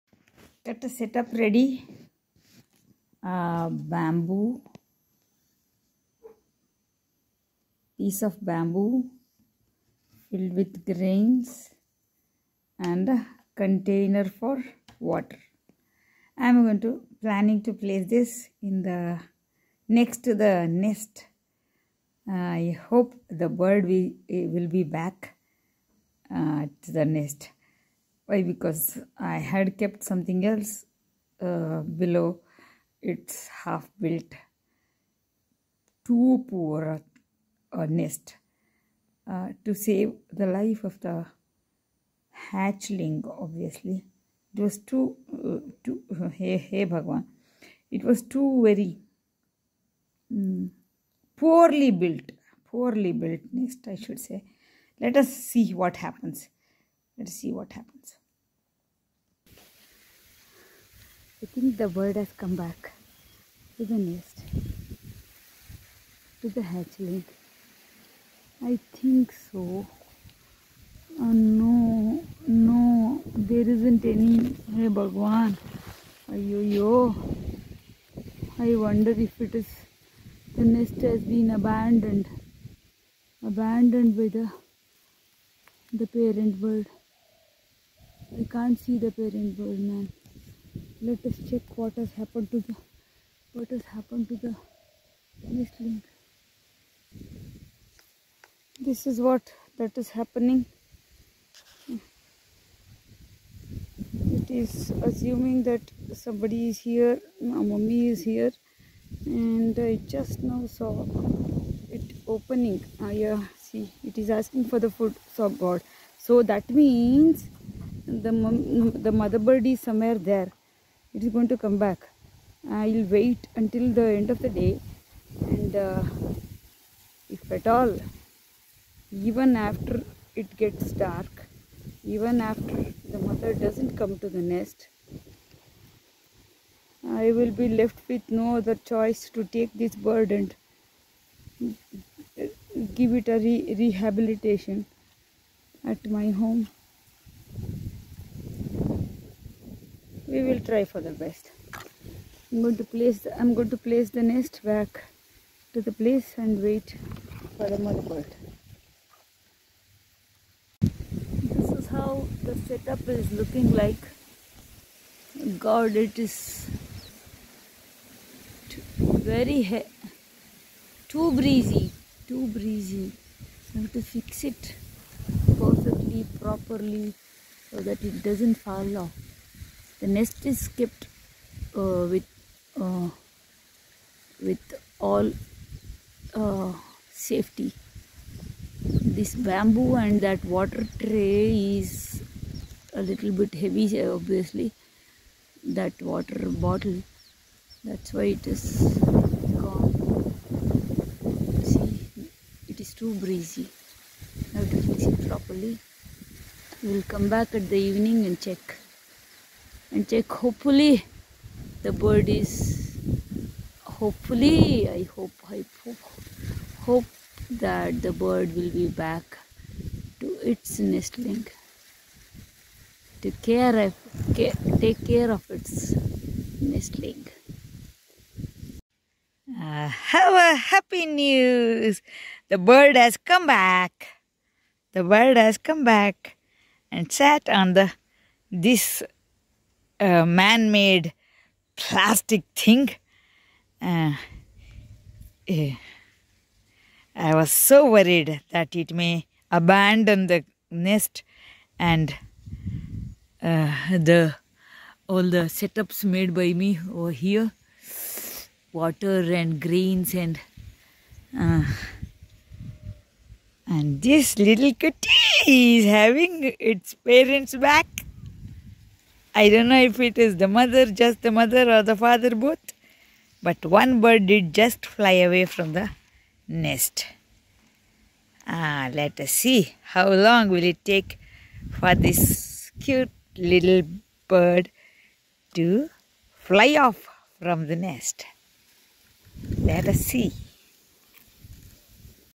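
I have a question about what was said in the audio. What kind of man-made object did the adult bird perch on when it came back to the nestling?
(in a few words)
Plastic thing.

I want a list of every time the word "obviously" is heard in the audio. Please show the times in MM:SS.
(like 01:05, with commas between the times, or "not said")
00:43, 03:14.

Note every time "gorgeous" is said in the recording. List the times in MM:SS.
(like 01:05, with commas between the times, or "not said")
not said.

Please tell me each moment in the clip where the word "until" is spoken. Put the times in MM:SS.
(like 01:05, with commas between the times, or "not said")
02:03.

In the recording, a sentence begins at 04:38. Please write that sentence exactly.
Ah, let us see how long will it take for this cute little bird to fly off from the nest.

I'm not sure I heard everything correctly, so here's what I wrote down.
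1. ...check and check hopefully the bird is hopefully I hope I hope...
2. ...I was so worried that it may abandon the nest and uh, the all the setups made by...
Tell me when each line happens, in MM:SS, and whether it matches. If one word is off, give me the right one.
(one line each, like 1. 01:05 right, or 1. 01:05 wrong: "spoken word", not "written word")
1. 03:28 right
2. 04:07 right.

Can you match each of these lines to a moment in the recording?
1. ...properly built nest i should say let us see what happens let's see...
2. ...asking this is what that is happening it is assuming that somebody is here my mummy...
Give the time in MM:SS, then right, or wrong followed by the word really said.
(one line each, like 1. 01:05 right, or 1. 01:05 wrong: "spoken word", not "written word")
1. 00:52 wrong: "poorly", not "properly"
2. 01:35 wrong: "nestling", not "asking".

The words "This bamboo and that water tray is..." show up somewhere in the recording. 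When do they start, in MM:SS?
03:08.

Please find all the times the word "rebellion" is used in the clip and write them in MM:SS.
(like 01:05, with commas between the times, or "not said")
not said.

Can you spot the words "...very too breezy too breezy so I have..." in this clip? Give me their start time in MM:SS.
02:49.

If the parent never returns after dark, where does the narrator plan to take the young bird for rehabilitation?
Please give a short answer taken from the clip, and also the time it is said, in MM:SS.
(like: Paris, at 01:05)
Home, at 02:25.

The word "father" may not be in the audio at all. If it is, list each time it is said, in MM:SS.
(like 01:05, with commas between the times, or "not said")
04:31.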